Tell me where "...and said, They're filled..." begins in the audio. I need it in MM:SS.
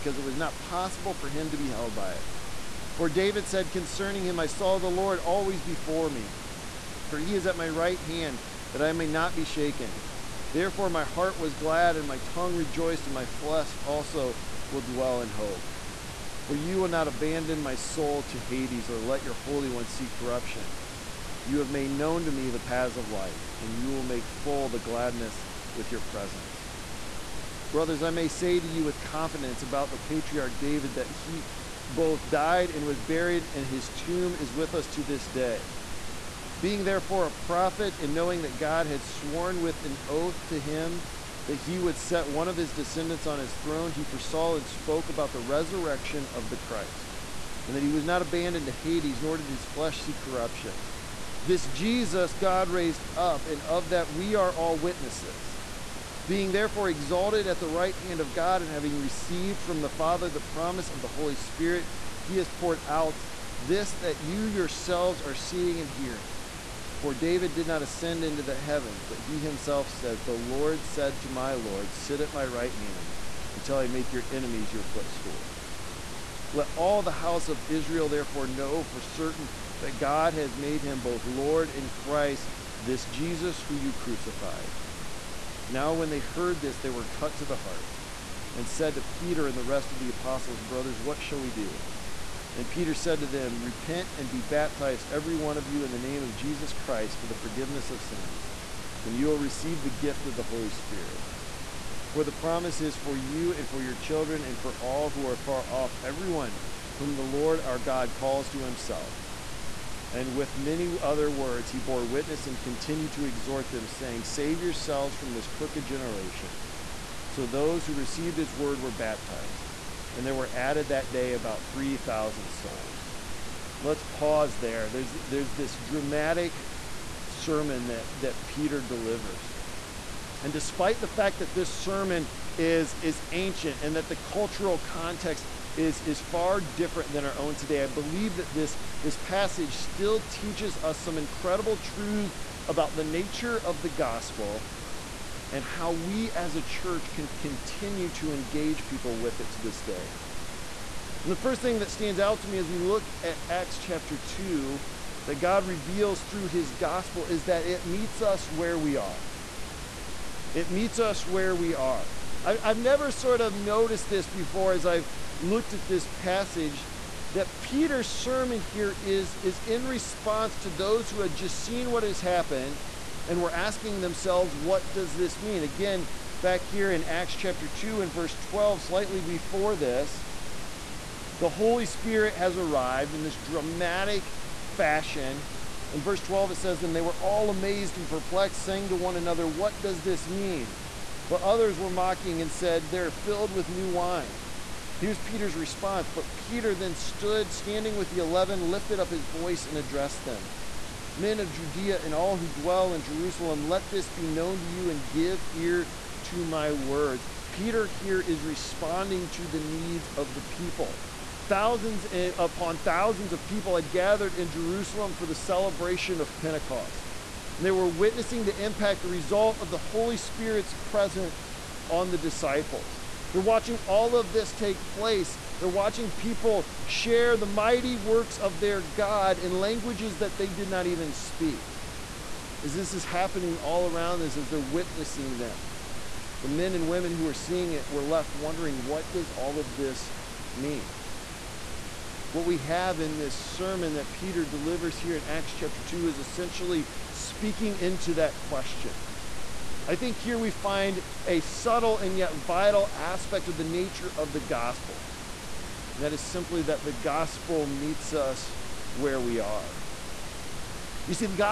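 03:12.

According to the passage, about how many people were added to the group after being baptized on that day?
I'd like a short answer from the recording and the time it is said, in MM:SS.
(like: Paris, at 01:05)
3,000, at 02:01.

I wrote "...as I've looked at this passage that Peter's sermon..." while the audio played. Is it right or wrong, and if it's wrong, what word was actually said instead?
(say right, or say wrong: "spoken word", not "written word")
right.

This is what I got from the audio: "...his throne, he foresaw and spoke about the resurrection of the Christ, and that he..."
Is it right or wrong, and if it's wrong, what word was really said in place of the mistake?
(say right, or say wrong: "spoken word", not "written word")
right.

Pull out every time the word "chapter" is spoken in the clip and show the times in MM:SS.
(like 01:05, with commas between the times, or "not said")
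02:33, 02:57, 04:05.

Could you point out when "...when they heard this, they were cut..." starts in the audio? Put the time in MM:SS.
01:25.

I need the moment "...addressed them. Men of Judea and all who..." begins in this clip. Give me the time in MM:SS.
03:19.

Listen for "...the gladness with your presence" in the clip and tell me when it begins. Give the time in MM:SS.
00:24.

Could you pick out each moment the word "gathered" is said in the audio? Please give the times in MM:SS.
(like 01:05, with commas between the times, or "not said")
03:33.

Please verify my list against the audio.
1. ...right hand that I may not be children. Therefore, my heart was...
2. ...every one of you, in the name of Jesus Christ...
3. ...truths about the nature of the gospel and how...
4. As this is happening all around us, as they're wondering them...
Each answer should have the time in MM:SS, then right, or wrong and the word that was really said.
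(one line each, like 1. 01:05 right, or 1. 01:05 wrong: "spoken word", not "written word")
1. 00:07 wrong: "shaken", not "children"
2. 01:35 right
3. 02:21 right
4. 03:52 wrong: "witnessing", not "wondering".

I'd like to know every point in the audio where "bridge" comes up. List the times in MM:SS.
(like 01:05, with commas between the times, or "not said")
not said.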